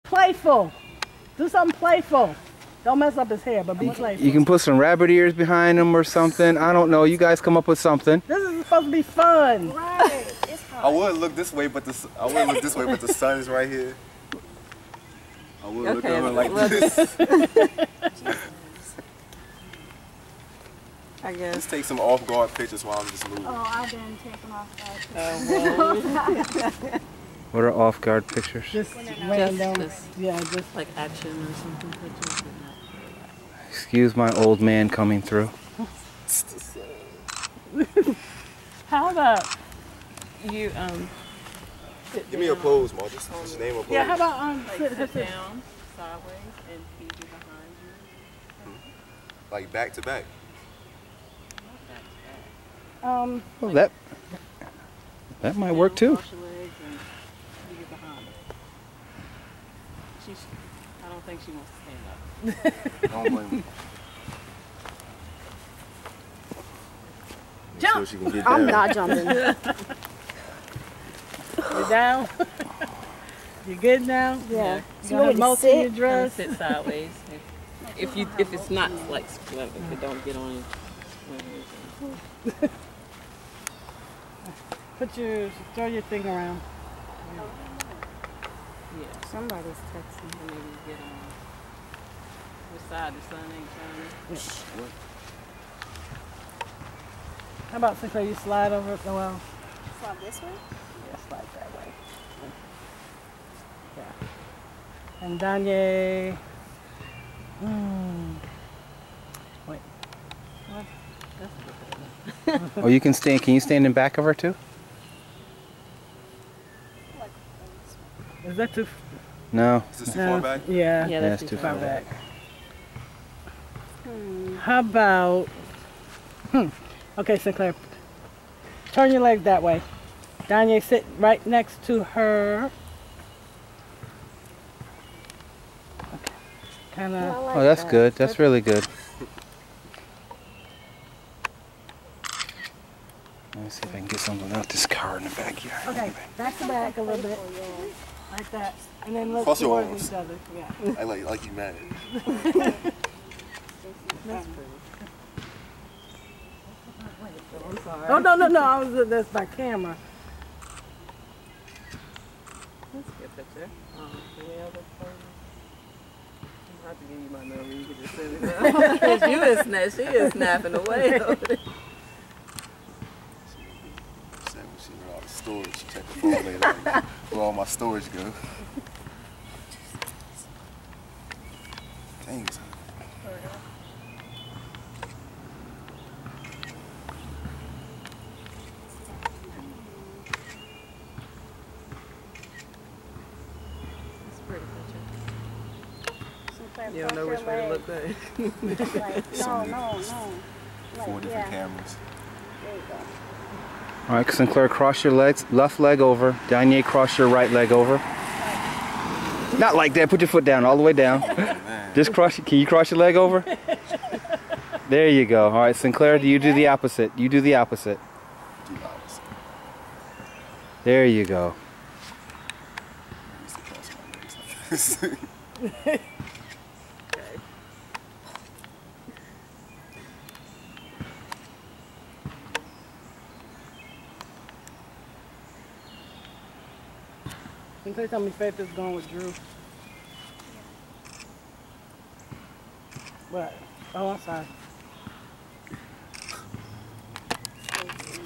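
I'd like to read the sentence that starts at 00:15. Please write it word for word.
I would okay, look over like this.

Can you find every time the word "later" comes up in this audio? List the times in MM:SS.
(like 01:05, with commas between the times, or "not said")
02:56.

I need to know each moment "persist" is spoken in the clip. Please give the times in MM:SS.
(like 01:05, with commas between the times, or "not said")
not said.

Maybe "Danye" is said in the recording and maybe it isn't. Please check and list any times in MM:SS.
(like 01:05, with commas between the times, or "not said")
01:45, 02:10, 03:26.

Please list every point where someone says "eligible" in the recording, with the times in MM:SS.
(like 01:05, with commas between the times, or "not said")
not said.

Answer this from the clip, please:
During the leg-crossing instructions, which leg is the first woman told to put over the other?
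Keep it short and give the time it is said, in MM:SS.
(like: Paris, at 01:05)
left leg, at 03:25.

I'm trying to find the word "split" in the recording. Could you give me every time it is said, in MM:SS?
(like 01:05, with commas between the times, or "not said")
01:19.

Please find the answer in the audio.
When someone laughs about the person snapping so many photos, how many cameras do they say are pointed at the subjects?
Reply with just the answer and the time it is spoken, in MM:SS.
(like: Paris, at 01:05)
4, at 03:21.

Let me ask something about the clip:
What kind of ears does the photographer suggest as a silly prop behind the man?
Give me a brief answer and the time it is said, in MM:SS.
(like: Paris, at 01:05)
rabbit ears, at 00:04.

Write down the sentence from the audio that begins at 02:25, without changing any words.
Okay, back to back a little bit like that, and then look Fossil toward ones.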